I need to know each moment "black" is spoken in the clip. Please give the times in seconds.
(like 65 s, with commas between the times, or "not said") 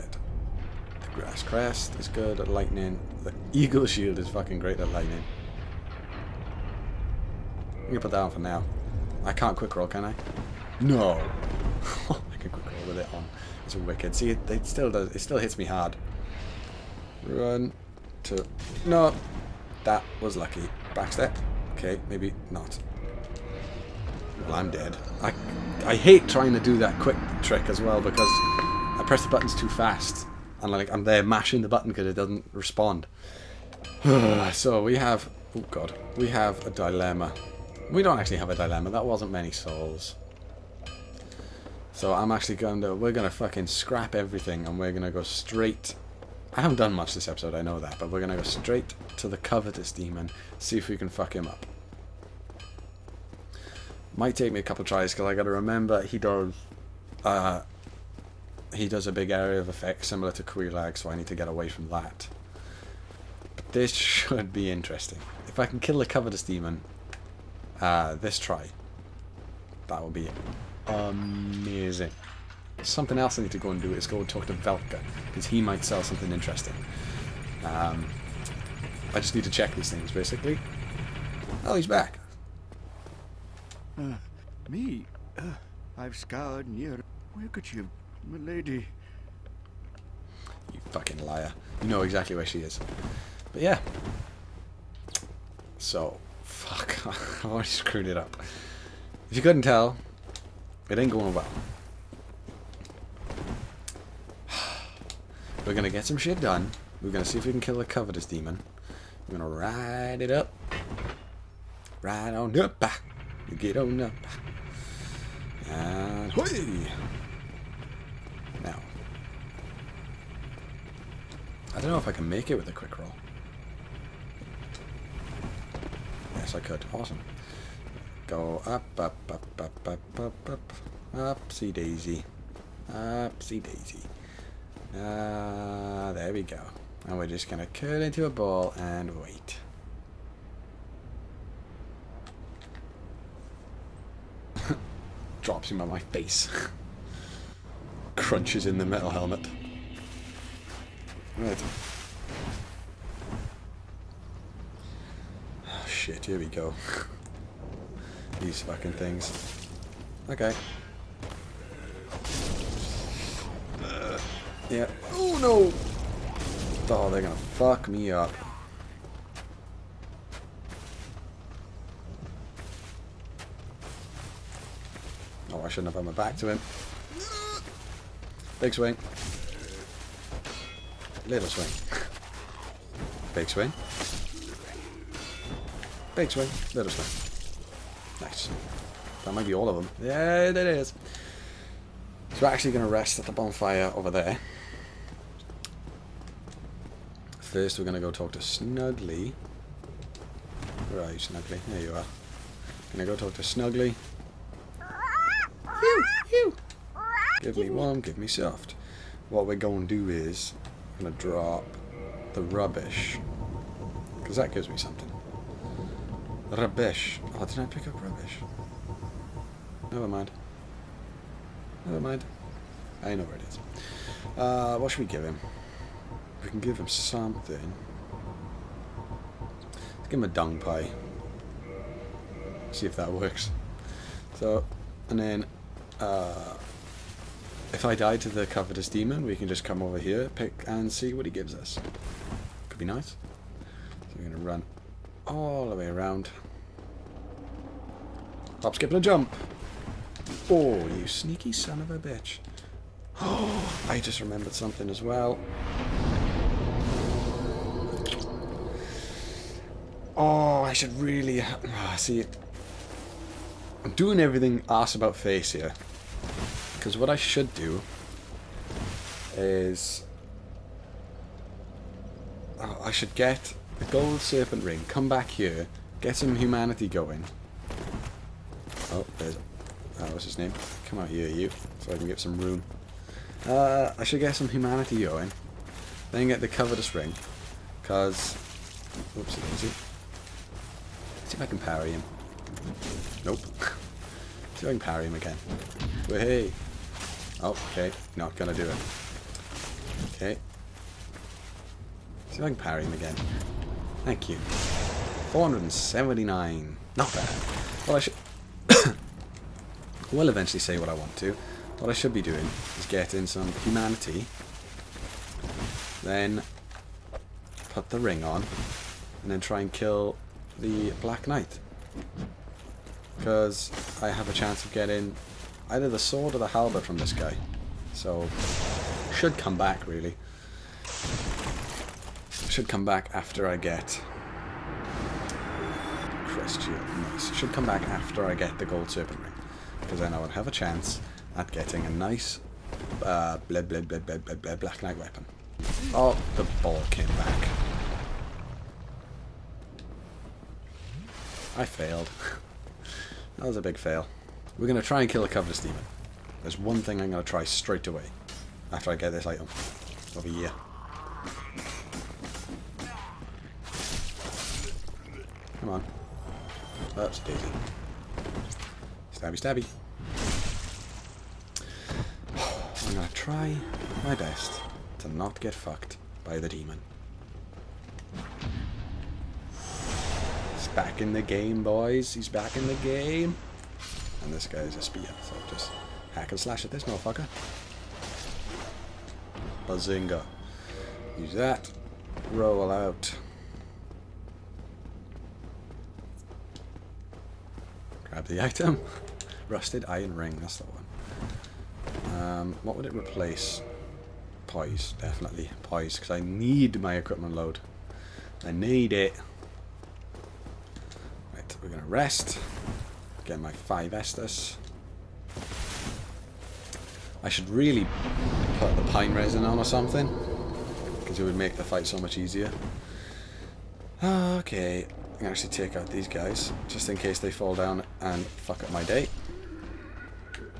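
321 s, 343 s.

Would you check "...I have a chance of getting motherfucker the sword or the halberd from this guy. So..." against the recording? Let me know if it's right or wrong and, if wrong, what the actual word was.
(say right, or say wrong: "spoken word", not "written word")
wrong: "either", not "motherfucker".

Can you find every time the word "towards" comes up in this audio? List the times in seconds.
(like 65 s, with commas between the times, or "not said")
not said.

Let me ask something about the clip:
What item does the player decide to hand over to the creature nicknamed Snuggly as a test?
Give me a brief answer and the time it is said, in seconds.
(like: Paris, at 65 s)
Dung pie, at 230 s.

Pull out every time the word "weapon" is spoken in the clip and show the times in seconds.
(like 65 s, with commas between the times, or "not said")
344 s.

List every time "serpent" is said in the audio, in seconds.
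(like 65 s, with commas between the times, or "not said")
274 s, 338 s.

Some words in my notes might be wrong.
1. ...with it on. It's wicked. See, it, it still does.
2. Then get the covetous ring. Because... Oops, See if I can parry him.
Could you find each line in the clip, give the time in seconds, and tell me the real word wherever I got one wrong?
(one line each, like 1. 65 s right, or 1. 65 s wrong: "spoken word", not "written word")
1. 12 s right
2. 286 s right.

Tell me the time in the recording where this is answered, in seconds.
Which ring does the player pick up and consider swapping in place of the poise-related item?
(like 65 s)
399 s.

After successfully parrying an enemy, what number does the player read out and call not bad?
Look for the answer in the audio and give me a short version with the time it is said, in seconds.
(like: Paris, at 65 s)
479, at 305 s.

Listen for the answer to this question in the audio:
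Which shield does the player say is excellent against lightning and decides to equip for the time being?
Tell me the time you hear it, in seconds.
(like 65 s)
3 s.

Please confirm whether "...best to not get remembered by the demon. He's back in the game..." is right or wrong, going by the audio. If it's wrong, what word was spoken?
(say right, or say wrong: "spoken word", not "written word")
wrong: "fucked", not "remembered".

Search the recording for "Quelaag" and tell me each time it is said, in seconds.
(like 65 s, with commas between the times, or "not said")
60 s.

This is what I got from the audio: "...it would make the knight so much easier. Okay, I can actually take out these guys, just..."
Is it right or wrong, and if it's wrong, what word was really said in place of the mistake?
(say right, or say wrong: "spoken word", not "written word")
wrong: "fight", not "knight".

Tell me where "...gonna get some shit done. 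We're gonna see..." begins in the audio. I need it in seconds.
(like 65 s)
105 s.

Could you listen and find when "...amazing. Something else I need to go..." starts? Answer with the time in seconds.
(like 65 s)
70 s.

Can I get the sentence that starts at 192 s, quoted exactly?
So we're actually going to rest at the bonfire over there.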